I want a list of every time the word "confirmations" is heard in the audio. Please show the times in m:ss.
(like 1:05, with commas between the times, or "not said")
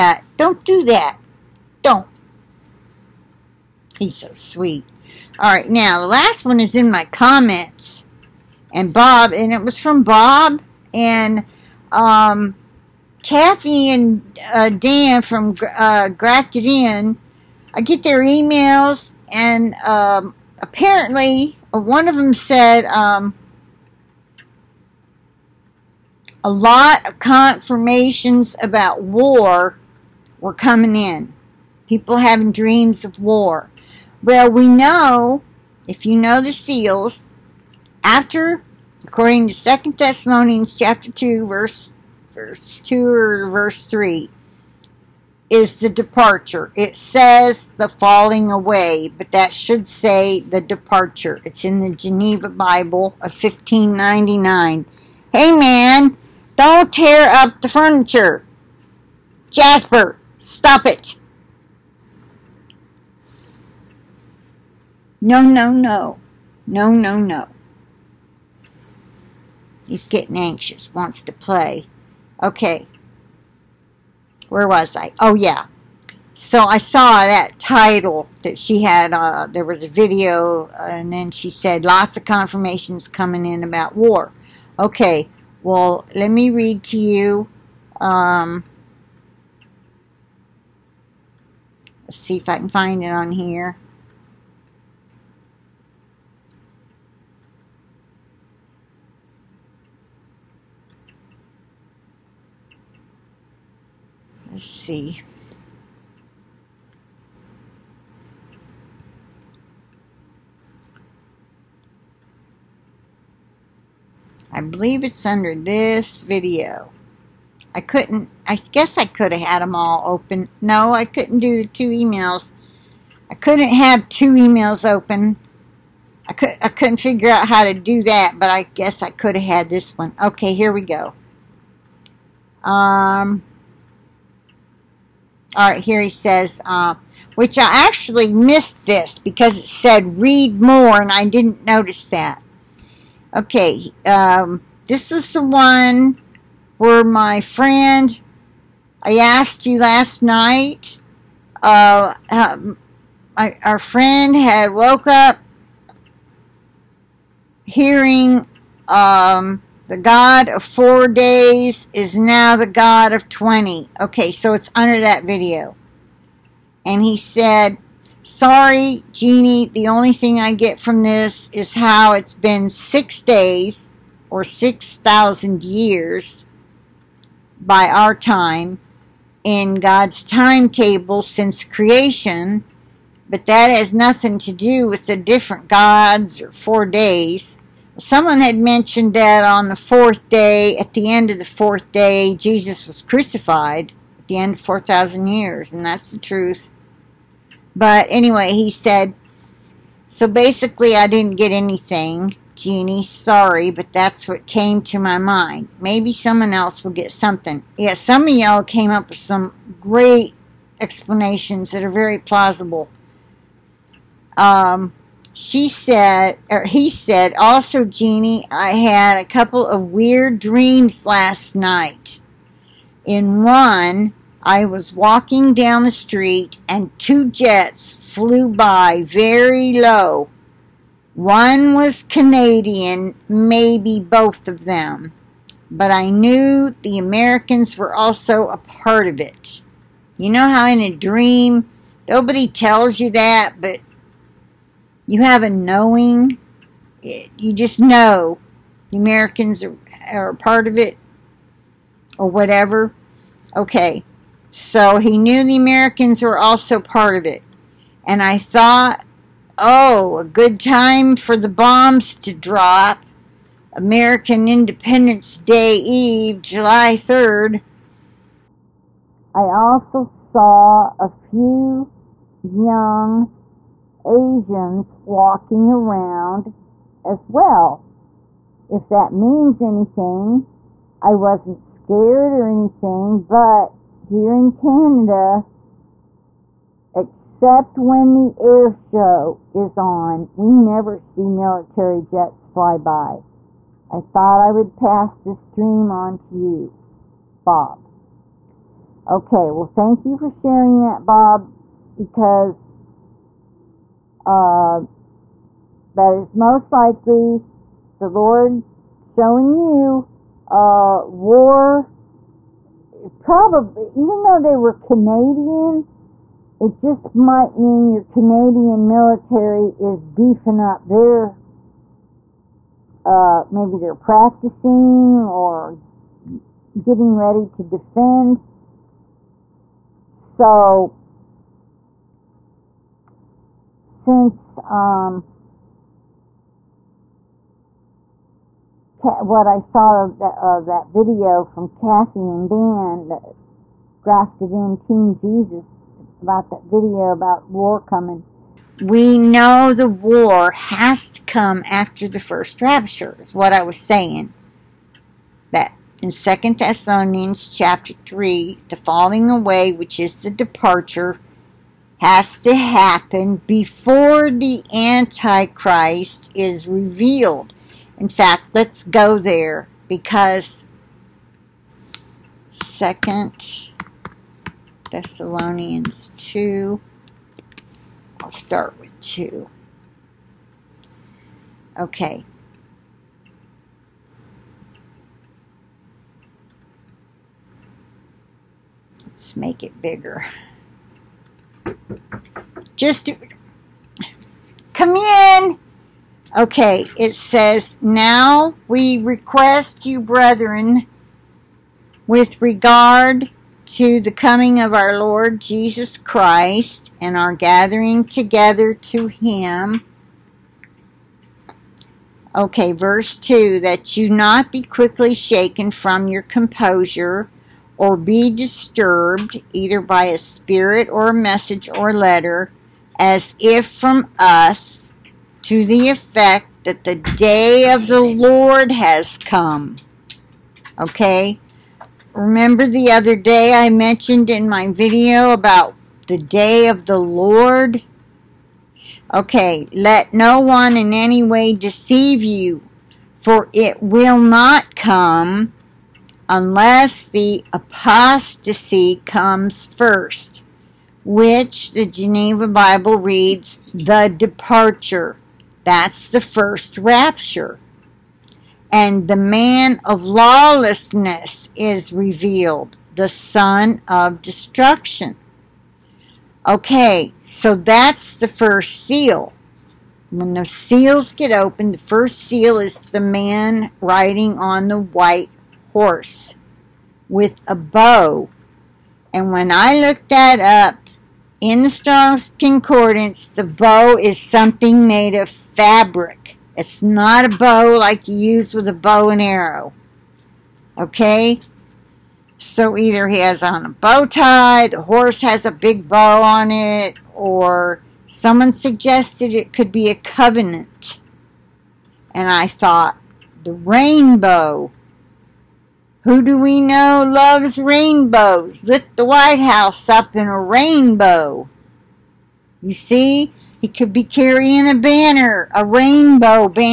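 0:27, 1:22.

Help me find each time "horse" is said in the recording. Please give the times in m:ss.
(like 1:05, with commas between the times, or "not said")
7:55, 8:14.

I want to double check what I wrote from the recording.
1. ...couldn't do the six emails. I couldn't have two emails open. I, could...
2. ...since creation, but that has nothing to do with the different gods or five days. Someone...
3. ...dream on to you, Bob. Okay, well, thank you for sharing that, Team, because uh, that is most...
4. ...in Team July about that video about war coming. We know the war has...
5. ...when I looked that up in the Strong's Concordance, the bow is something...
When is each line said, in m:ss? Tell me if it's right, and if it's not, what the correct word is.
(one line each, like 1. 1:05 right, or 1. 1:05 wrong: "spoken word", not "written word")
1. 2:01 wrong: "two", not "six"
2. 3:01 wrong: "four", not "five"
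3. 4:55 wrong: "Bob", not "Team"
4. 5:44 wrong: "Jesus", not "July"
5. 7:59 right.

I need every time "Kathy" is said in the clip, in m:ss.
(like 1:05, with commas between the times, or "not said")
0:13, 5:41.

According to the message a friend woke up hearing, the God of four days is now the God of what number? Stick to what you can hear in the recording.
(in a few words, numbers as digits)
20.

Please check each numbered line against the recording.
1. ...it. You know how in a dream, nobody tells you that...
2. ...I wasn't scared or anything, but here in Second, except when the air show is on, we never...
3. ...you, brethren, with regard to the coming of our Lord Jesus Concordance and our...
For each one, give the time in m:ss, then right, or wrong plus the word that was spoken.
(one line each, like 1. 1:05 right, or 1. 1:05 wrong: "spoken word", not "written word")
1. 3:59 right
2. 4:41 wrong: "Canada", not "Second"
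3. 6:39 wrong: "Christ", not "Concordance".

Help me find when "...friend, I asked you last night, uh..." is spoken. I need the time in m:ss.
2:27.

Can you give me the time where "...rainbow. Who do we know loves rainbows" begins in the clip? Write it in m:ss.
8:23.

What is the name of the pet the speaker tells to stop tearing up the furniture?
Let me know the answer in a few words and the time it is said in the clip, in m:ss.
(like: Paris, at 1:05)
Jasper, at 0:59.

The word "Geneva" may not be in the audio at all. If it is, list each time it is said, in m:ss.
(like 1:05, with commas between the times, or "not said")
0:51, 7:31.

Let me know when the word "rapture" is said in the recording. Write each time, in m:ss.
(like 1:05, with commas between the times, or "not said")
5:52, 7:36.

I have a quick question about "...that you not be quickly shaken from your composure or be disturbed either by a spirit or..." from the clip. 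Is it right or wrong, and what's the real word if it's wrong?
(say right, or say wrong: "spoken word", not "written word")
right.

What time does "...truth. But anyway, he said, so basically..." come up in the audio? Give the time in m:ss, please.
3:16.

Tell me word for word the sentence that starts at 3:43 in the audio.
In one, I was walking down the street and two jets flew by very low.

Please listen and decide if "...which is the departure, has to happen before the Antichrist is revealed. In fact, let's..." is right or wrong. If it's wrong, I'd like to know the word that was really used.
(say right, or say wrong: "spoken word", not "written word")
right.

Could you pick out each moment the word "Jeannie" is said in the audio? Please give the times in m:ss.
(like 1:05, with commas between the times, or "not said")
2:49, 3:22, 3:37.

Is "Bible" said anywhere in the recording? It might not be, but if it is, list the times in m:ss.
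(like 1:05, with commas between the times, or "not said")
0:52, 7:32.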